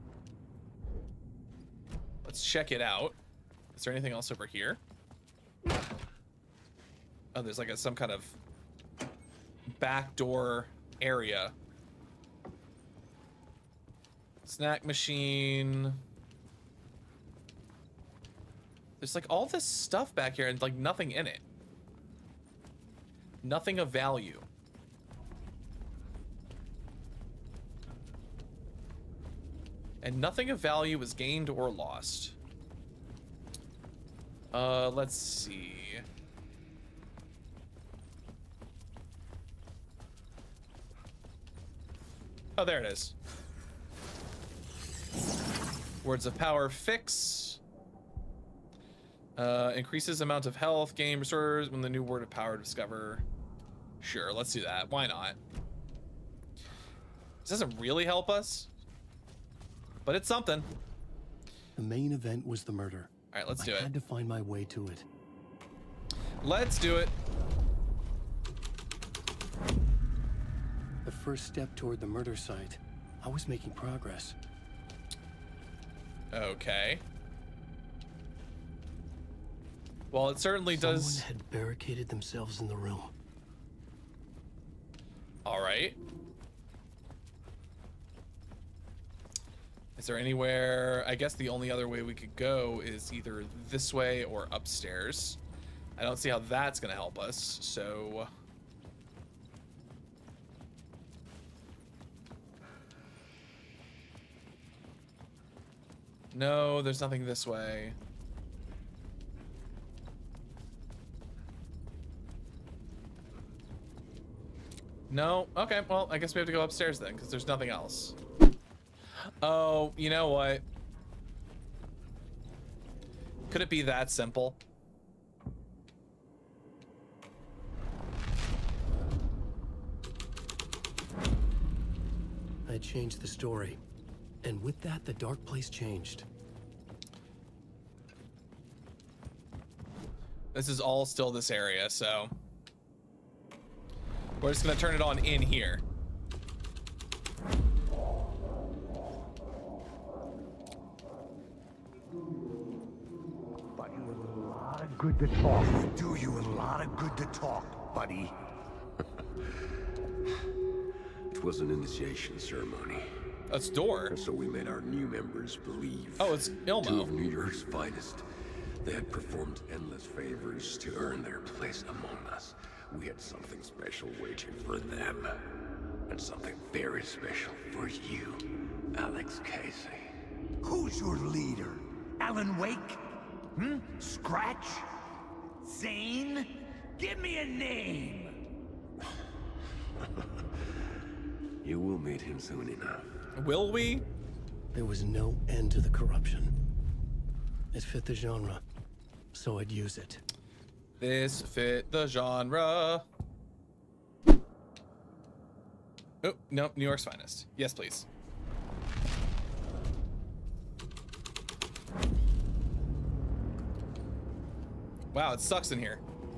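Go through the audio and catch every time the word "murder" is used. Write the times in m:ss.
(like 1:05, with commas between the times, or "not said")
1:02, 1:12.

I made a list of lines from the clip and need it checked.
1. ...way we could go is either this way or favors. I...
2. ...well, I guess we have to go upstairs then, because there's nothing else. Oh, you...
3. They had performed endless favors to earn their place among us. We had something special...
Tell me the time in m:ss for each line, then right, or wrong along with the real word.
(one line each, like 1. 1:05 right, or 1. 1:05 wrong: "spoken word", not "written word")
1. 1:31 wrong: "upstairs", not "favors"
2. 1:55 right
3. 2:48 right.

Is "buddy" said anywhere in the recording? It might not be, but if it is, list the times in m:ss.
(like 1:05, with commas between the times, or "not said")
2:26, 2:37.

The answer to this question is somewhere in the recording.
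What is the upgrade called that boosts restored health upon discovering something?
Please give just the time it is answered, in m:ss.
0:46.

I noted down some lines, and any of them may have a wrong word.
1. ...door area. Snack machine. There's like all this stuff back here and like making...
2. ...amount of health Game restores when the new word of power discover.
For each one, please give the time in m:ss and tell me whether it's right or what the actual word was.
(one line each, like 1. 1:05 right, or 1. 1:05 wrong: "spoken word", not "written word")
1. 0:10 wrong: "nothing", not "making"
2. 0:50 right.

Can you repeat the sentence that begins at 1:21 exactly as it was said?
Someone had barricaded themselves in the room.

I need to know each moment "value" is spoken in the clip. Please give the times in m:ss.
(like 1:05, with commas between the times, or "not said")
0:23, 0:30.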